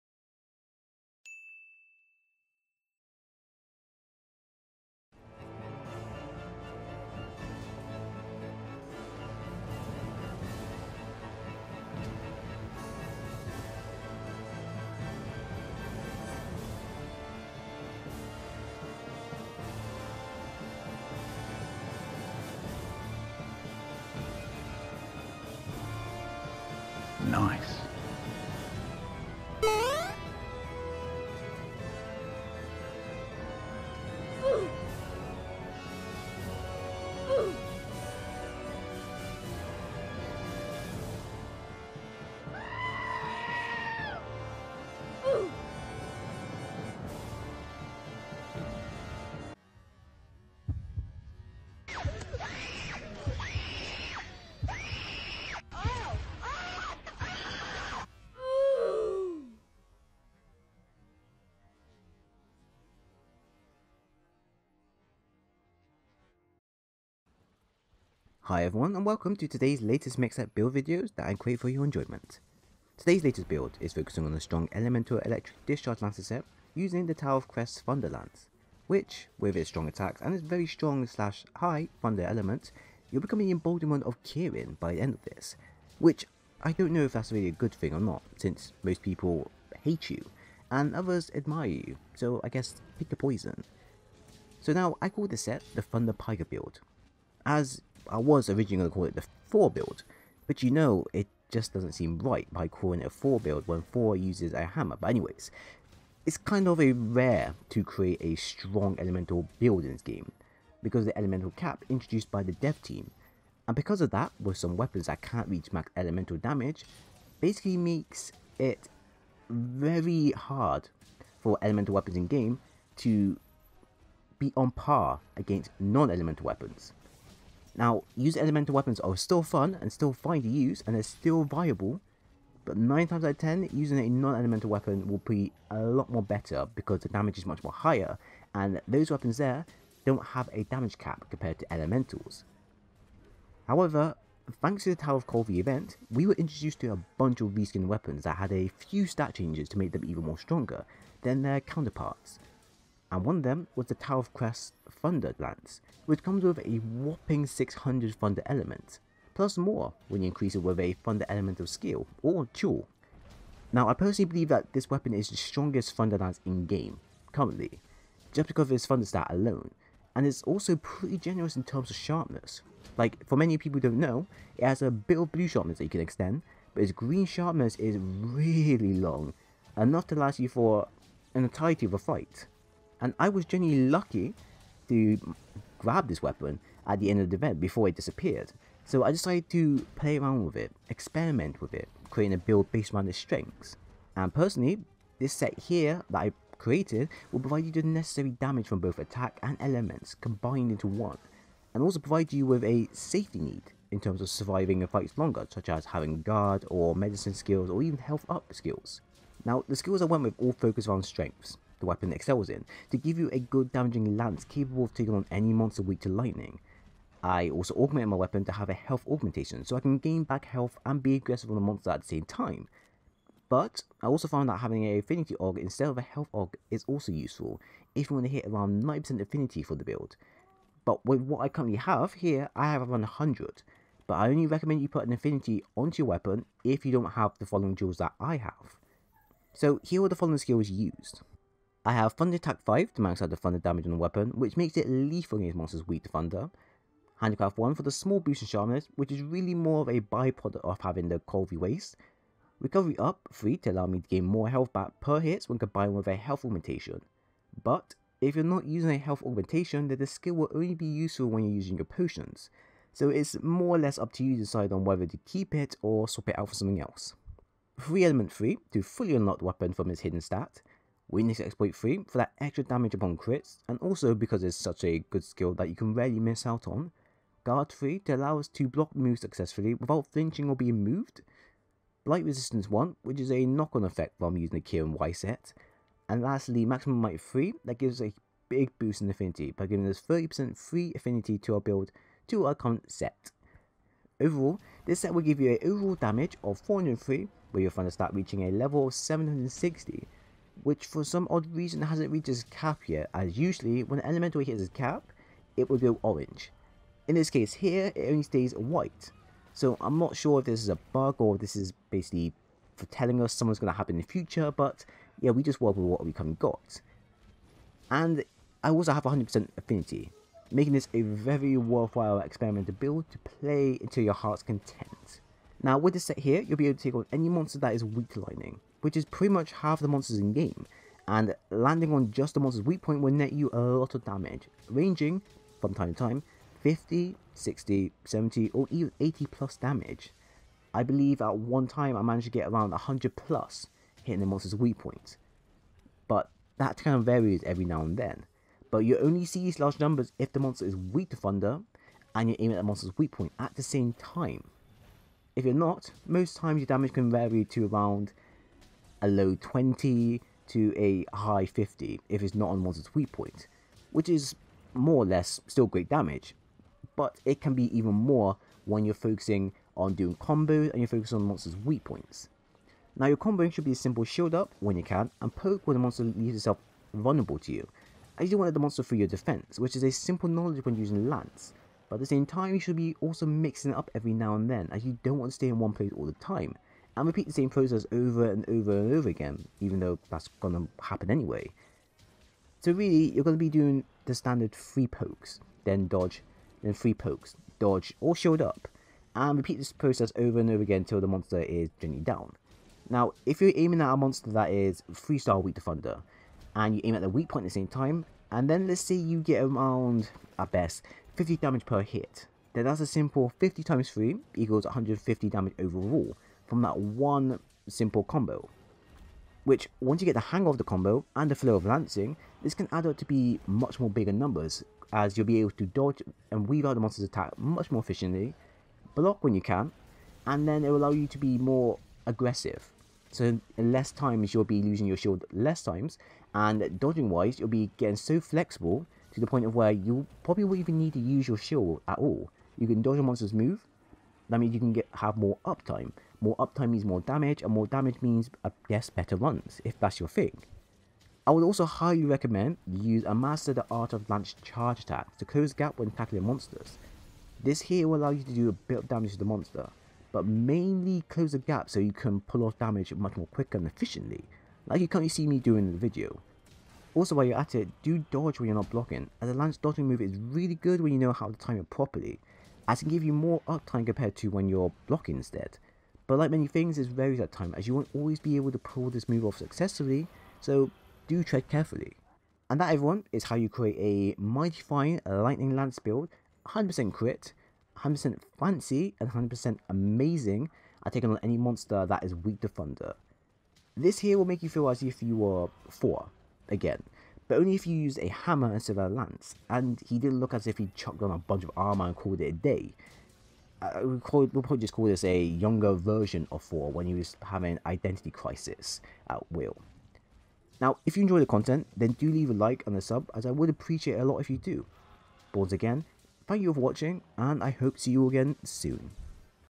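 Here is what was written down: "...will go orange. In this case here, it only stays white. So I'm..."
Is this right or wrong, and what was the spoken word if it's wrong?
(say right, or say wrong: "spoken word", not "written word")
right.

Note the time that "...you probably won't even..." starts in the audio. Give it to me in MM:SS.
07:19.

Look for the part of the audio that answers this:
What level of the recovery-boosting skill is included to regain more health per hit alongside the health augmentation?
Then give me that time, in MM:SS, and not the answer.
04:12.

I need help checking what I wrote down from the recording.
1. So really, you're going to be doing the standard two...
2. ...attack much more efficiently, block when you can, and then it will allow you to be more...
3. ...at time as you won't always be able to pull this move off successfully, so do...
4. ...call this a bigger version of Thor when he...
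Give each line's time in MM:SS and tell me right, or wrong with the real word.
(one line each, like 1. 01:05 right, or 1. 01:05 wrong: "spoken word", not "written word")
1. 06:32 wrong: "three", not "two"
2. 07:07 right
3. 07:57 right
4. 08:24 wrong: "younger", not "bigger".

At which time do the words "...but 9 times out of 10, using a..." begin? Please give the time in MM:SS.
02:12.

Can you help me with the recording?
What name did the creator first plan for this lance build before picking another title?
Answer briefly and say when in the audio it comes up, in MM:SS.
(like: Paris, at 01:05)
The Thor build, at 01:39.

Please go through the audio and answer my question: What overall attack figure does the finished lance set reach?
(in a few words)
403.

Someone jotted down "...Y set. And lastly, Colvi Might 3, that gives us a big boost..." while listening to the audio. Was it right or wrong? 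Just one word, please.
wrong.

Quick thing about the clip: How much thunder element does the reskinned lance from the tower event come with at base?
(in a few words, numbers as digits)
600.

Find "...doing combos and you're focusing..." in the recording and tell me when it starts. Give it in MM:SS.
06:09.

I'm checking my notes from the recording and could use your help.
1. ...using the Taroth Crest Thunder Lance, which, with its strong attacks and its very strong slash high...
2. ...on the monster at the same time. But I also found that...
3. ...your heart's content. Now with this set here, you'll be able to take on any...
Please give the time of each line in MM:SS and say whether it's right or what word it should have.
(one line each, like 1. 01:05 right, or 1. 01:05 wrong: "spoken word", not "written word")
1. 01:16 right
2. 03:41 right
3. 05:24 right.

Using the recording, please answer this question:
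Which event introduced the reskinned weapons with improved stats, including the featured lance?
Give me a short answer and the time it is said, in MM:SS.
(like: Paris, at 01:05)
Tower of Colvi, at 02:24.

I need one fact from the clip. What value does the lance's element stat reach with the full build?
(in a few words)
760.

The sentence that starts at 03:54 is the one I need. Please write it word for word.
But I only recommend you put an affinity onto your weapon if you don't have the following jewels that I have.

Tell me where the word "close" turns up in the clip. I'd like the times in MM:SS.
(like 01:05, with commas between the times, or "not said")
07:35, 07:41.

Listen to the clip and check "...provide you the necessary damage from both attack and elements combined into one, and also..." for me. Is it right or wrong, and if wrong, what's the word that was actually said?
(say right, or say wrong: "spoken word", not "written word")
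right.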